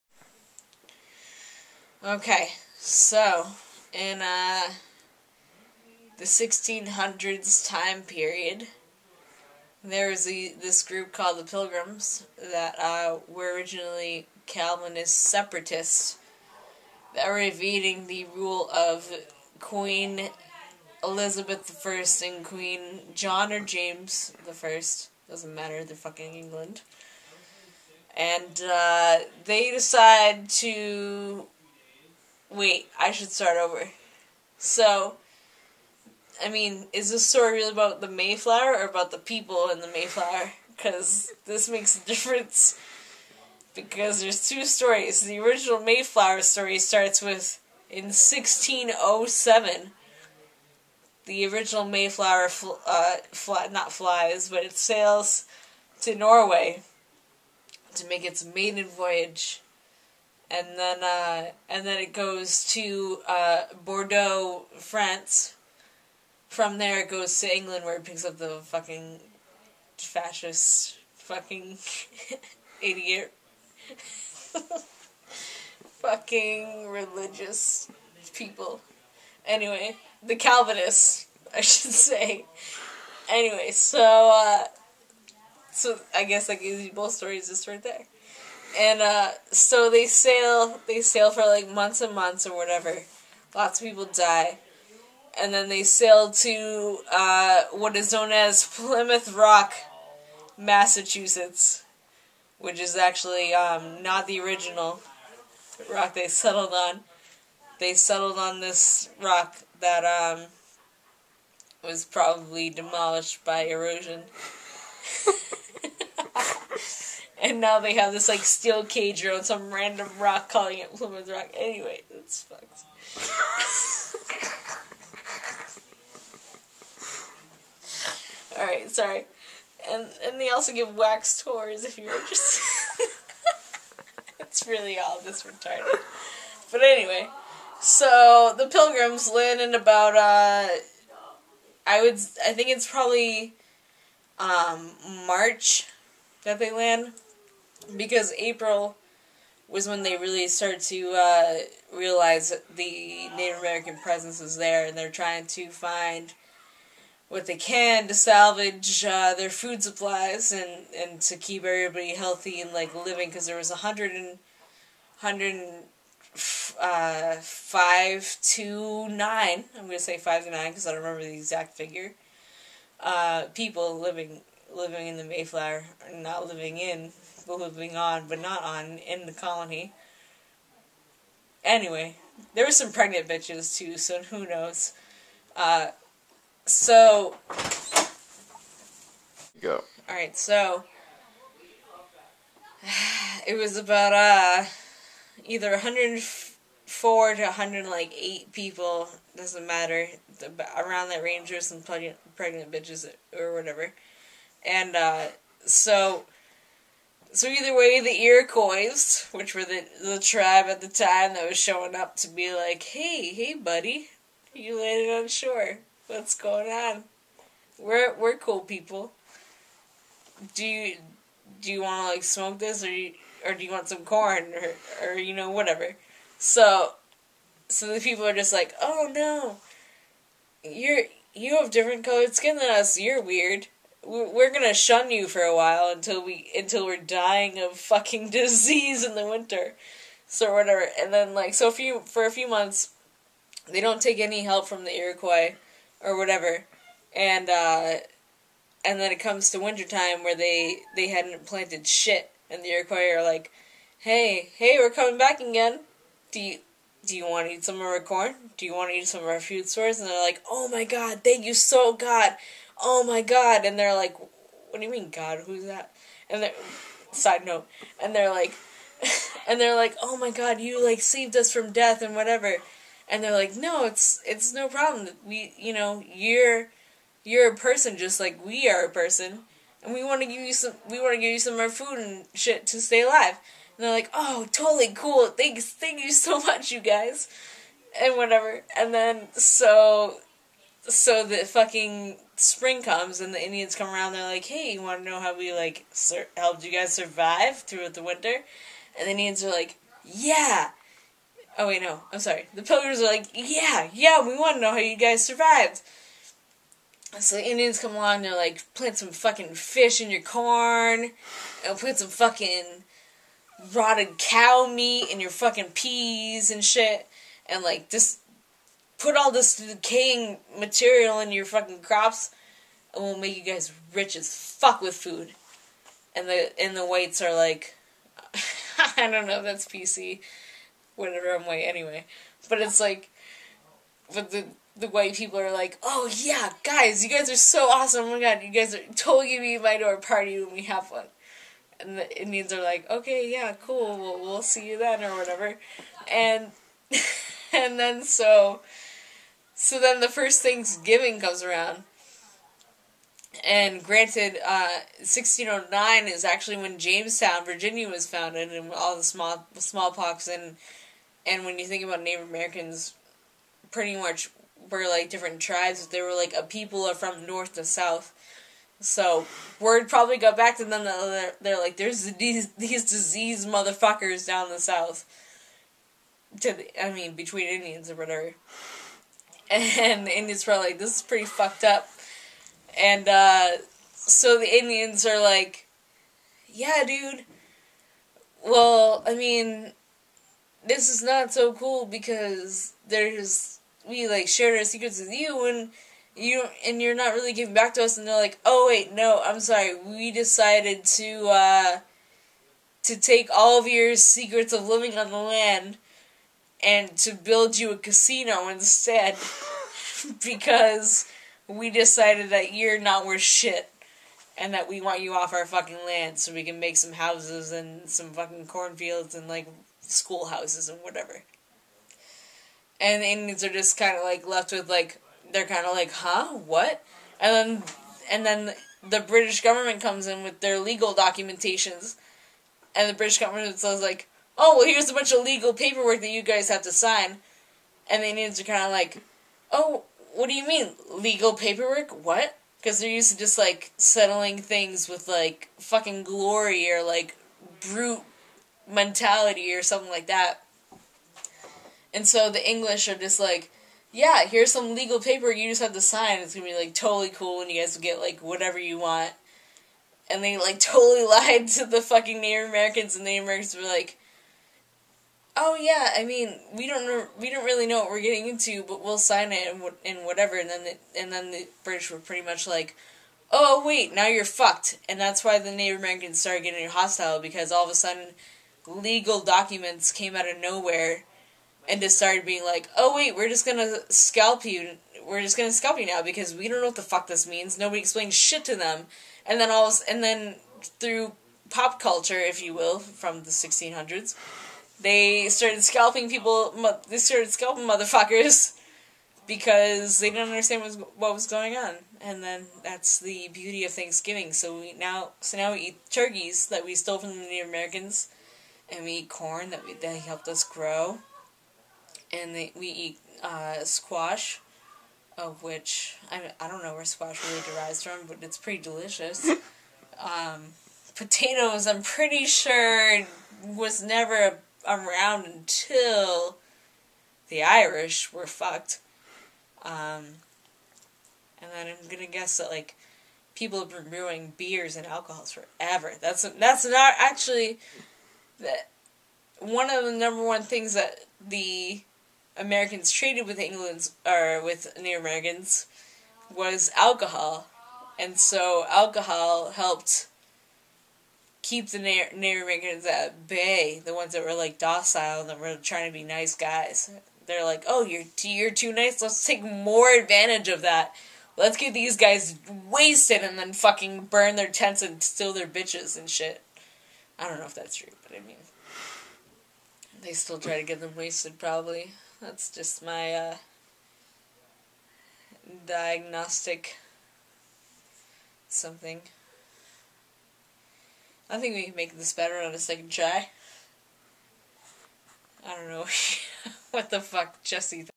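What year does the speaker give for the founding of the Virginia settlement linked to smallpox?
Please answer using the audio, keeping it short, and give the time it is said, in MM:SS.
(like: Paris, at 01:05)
1609, at 05:54.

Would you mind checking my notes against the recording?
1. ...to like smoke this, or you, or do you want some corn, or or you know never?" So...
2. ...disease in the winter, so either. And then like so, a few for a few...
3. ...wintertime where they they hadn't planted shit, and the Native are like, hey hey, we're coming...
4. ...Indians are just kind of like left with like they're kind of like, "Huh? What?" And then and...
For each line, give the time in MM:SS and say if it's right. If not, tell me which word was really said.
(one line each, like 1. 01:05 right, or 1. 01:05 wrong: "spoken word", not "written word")
1. 03:42 wrong: "whatever", not "never"
2. 03:58 wrong: "whatever", not "either"
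3. 04:09 wrong: "Iroquois", not "Native"
4. 07:03 right.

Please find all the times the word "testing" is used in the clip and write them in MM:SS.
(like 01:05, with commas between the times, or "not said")
not said.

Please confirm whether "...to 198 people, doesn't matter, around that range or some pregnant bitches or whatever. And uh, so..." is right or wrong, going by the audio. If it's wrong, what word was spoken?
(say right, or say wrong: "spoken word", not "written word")
wrong: "108", not "198".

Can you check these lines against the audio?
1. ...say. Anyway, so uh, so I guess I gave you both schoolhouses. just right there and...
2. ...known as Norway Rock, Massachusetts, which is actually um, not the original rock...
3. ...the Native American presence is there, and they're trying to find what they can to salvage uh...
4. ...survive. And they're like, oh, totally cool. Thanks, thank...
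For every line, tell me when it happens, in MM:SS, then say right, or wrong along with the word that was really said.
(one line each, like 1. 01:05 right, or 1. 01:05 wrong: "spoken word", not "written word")
1. 01:21 wrong: "stories", not "schoolhouses"
2. 01:38 wrong: "Plymouth", not "Norway"
3. 02:32 right
4. 04:43 wrong: "alive", not "survive".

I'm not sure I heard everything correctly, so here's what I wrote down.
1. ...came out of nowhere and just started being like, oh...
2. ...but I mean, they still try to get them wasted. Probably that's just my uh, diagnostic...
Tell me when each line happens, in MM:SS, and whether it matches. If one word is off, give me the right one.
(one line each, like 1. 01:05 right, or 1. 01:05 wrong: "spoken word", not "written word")
1. 07:59 right
2. 09:28 right.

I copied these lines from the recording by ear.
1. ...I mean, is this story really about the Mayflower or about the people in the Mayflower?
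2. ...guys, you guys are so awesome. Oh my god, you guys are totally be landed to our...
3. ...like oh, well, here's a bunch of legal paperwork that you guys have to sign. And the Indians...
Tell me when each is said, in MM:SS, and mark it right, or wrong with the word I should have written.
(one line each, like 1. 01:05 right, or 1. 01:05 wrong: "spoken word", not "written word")
1. 00:36 right
2. 05:36 wrong: "invited", not "landed"
3. 07:13 right.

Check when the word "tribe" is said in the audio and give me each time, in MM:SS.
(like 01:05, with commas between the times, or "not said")
03:30, 06:05.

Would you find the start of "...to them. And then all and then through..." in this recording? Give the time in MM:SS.
08:08.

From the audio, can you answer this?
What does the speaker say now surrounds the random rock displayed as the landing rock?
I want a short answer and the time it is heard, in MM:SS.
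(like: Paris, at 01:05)
steel cage, at 01:58.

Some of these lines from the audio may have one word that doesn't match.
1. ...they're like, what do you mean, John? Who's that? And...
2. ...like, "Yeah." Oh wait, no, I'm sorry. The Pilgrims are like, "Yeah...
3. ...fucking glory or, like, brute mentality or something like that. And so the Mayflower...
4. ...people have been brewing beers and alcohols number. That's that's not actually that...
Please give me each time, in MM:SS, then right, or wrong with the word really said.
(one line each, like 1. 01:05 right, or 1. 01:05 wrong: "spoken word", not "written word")
1. 04:23 wrong: "God", not "John"
2. 04:59 right
3. 07:25 wrong: "English", not "Mayflower"
4. 08:53 wrong: "forever", not "number".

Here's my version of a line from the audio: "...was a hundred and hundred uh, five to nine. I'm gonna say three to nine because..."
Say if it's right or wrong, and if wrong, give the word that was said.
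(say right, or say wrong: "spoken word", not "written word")
wrong: "five", not "three".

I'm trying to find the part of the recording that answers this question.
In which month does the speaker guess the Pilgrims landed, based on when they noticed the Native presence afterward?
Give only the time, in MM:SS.
02:25.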